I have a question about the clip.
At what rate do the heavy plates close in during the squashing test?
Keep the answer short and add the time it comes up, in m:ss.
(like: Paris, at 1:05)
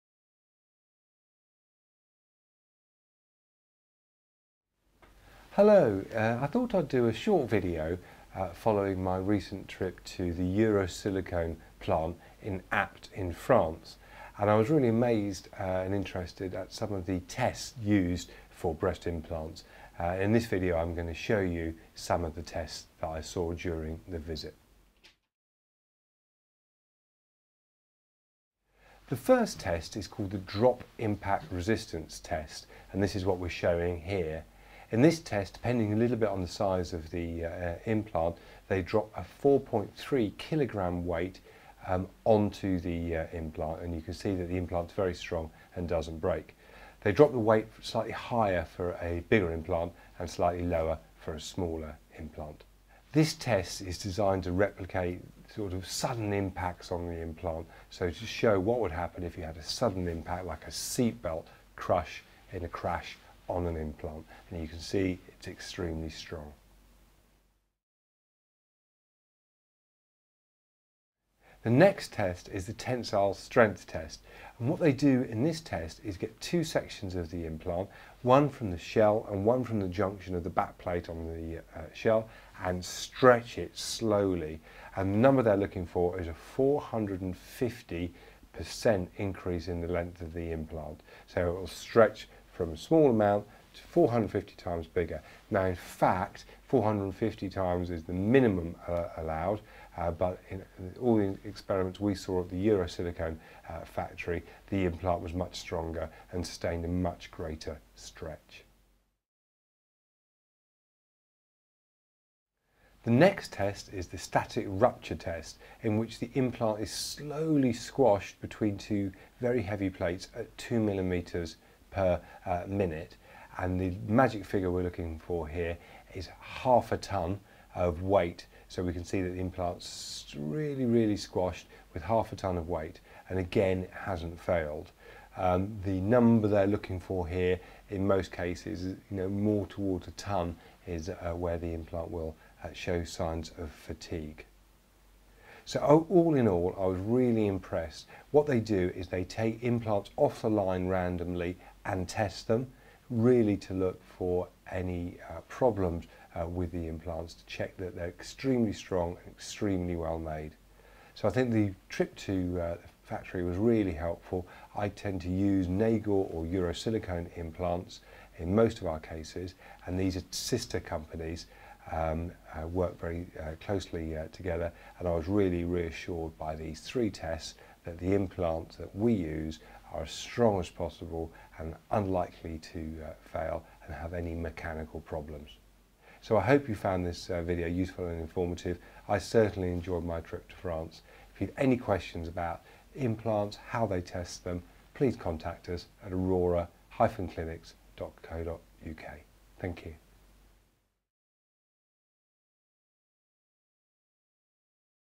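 2 millimetres per minute, at 2:00.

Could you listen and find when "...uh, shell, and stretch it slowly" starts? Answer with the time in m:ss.
1:21.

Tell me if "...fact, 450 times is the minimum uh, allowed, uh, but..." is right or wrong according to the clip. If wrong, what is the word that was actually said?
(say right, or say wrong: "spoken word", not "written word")
right.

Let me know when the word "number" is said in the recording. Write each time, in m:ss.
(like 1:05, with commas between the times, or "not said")
1:25, 2:16.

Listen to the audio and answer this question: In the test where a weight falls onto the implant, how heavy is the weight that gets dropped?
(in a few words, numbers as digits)
4.3 kg.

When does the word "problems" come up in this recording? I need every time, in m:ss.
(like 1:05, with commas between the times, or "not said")
2:35, 3:05.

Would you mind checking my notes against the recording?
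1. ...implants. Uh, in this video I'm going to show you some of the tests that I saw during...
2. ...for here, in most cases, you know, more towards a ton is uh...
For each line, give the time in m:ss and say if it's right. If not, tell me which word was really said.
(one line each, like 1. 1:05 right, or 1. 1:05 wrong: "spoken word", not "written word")
1. 0:19 right
2. 2:16 right.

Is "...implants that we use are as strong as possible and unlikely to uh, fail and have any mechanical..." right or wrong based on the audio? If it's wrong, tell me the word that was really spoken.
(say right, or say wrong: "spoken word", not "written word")
right.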